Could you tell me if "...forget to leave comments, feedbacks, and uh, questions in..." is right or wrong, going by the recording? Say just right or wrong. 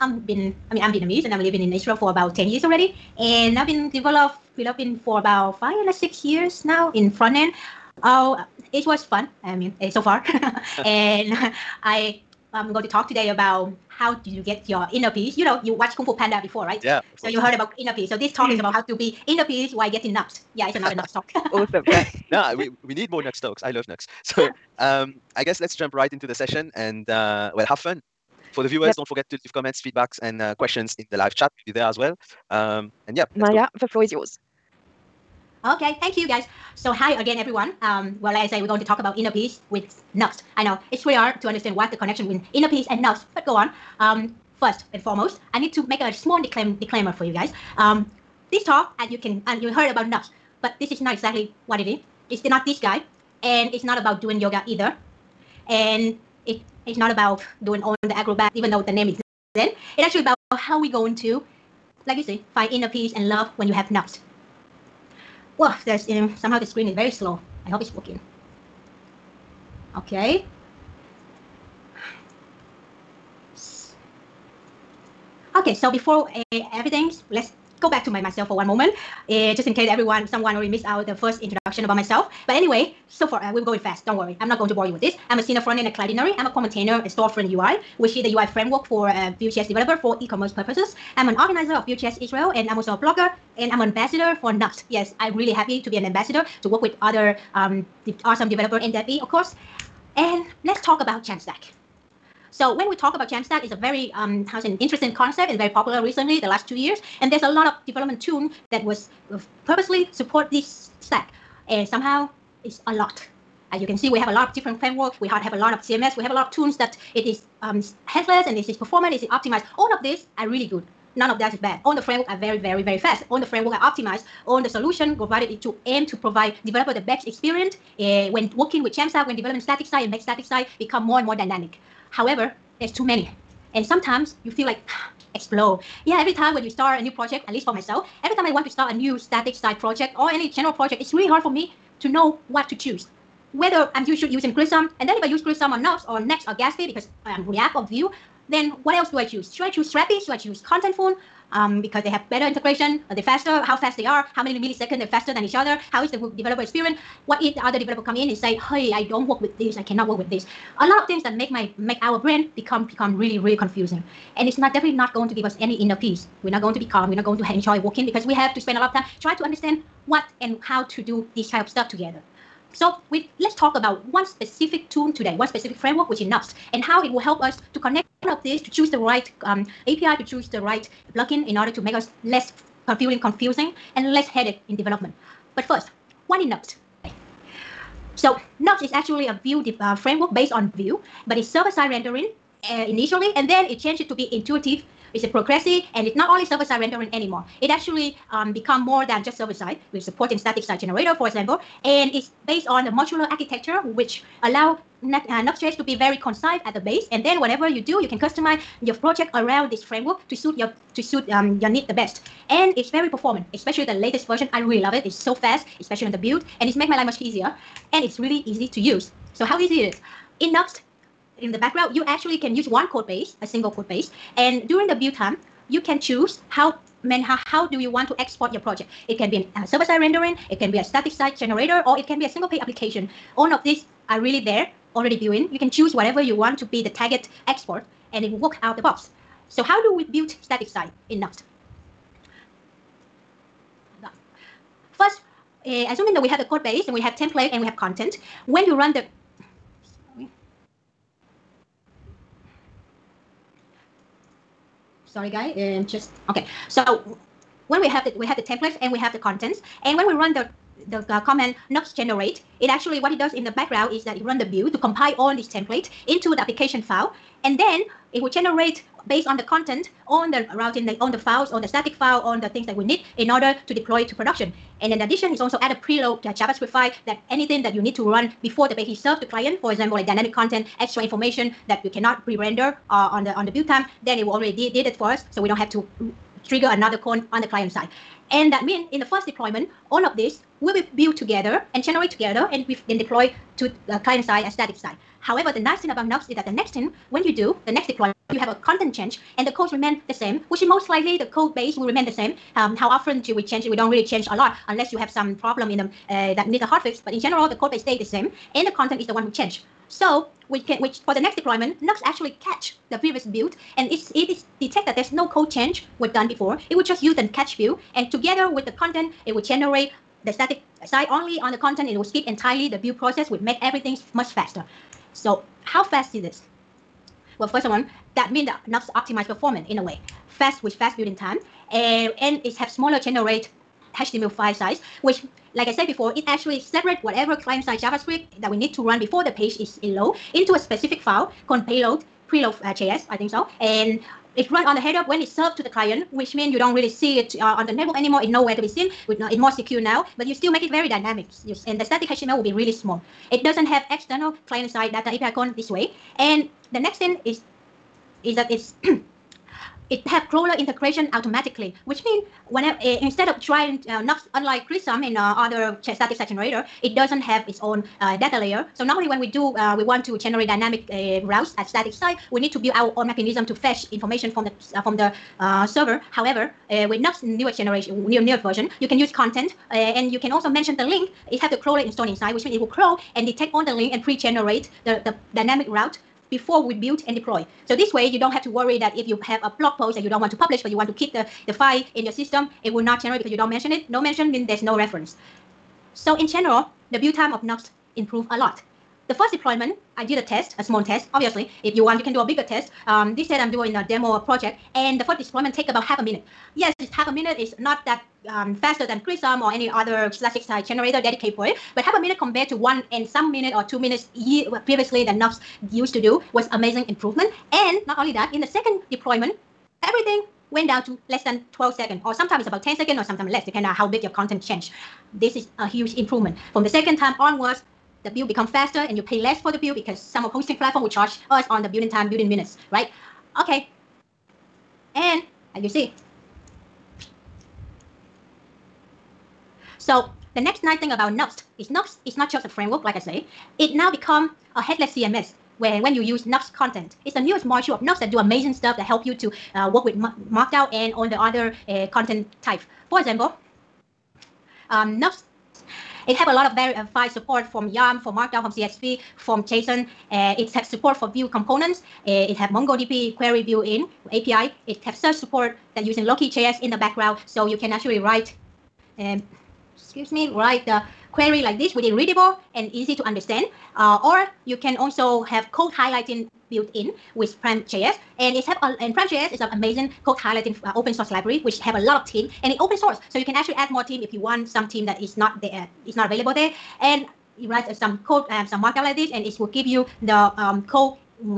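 right.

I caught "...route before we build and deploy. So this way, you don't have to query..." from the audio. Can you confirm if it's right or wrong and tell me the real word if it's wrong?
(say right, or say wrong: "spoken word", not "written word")
wrong: "worry", not "query".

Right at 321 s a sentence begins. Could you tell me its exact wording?
It will skip entirely the build process, which make everything much faster.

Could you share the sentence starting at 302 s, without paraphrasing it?
Um, how often do we change it?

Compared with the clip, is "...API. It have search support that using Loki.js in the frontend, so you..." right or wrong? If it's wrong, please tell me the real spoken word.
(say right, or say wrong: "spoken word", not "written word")
wrong: "background", not "frontend".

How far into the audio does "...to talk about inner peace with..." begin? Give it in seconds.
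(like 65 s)
38 s.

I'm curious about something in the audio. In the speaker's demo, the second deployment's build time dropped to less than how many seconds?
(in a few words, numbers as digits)
12.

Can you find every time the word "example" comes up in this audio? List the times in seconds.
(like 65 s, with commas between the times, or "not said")
201 s, 279 s, 452 s.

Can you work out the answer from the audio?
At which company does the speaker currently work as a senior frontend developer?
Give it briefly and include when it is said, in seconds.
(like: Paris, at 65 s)
Cloudinary, at 85 s.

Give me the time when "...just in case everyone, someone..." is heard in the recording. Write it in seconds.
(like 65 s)
79 s.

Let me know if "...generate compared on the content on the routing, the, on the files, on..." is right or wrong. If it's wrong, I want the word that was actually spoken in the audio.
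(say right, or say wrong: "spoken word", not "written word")
wrong: "based", not "compared".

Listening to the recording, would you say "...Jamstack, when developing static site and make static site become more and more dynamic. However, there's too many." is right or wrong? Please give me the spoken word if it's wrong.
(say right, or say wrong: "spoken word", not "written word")
right.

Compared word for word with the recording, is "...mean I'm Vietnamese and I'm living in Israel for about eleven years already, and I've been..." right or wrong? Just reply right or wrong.
wrong.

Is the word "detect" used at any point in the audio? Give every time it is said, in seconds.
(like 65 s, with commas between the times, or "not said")
314 s, 383 s.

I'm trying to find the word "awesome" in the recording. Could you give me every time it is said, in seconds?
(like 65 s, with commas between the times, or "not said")
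21 s, 98 s.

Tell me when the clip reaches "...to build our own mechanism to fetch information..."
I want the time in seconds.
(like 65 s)
372 s.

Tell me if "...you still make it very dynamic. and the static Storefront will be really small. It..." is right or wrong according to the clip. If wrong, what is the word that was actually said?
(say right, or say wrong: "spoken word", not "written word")
wrong: "HTML", not "Storefront".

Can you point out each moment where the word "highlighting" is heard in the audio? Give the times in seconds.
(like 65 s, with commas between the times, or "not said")
475 s, 480 s.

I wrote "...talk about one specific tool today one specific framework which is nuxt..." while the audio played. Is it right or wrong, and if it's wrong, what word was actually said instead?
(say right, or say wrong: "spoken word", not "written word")
right.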